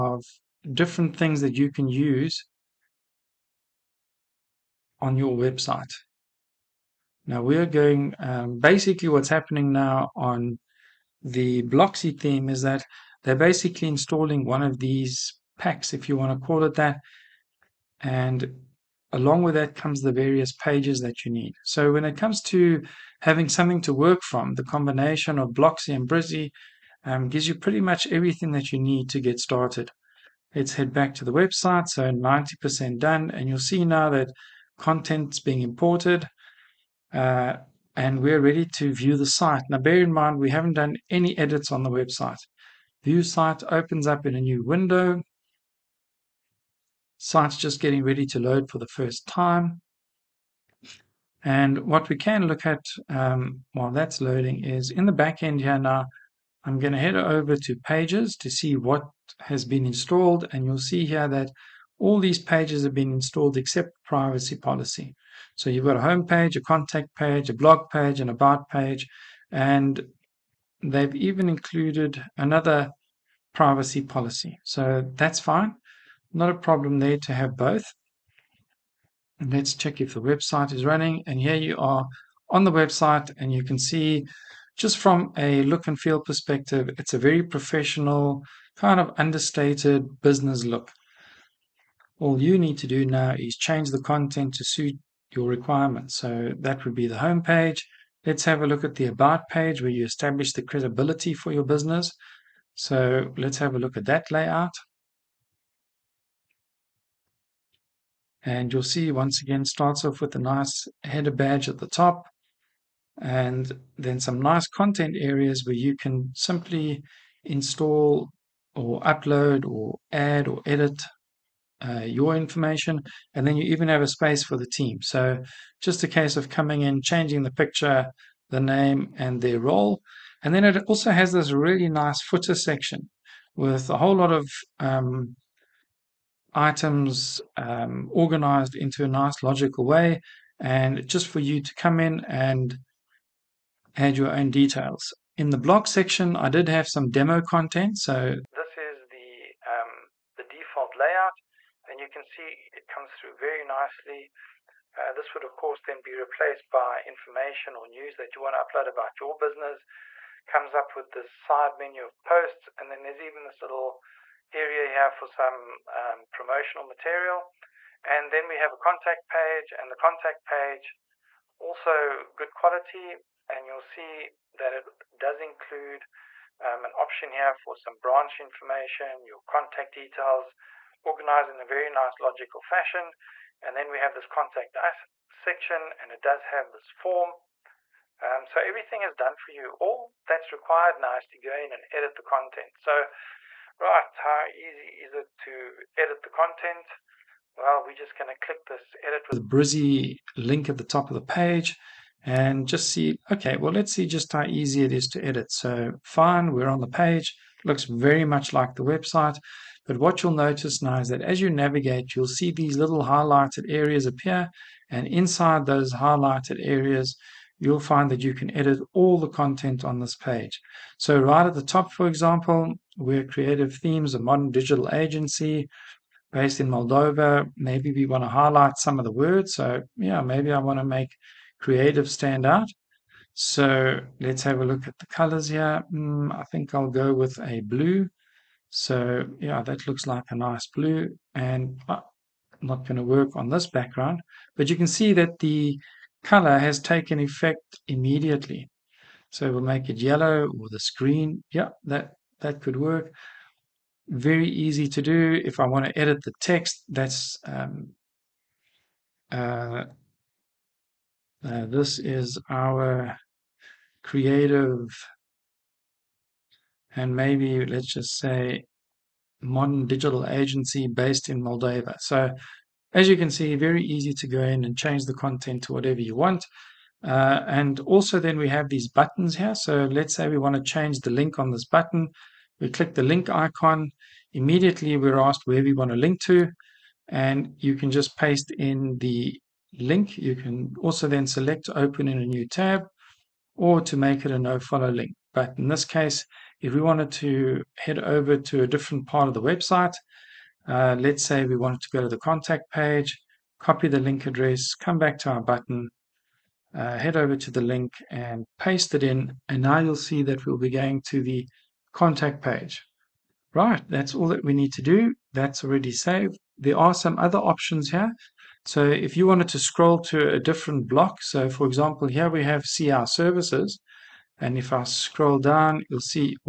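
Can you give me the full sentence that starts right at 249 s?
So we'll make it yellow or the screen.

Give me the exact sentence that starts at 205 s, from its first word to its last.
So fine, we're on the page.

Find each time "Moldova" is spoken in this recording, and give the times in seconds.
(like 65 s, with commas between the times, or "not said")
226 s, 271 s.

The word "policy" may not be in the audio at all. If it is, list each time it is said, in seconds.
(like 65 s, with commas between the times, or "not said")
64 s, 74 s.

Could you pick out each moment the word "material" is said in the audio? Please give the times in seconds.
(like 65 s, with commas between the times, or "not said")
166 s.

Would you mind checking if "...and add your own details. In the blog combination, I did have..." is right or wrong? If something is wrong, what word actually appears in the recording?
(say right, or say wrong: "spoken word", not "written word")
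wrong: "section", not "combination".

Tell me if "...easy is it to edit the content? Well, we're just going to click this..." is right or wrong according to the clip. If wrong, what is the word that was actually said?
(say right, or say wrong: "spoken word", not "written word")
right.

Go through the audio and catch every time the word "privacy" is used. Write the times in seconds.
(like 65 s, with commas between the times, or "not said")
64 s, 73 s.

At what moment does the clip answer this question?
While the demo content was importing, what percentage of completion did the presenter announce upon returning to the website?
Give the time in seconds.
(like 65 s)
32 s.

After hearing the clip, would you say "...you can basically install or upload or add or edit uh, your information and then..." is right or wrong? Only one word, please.
wrong.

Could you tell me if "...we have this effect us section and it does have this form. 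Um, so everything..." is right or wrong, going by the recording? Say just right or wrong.
wrong.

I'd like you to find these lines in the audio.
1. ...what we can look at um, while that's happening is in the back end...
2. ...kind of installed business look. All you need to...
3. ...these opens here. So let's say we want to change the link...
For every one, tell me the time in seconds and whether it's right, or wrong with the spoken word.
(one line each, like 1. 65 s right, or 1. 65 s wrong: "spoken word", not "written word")
1. 51 s wrong: "loading", not "happening"
2. 88 s wrong: "understated", not "installed"
3. 278 s wrong: "buttons", not "opens".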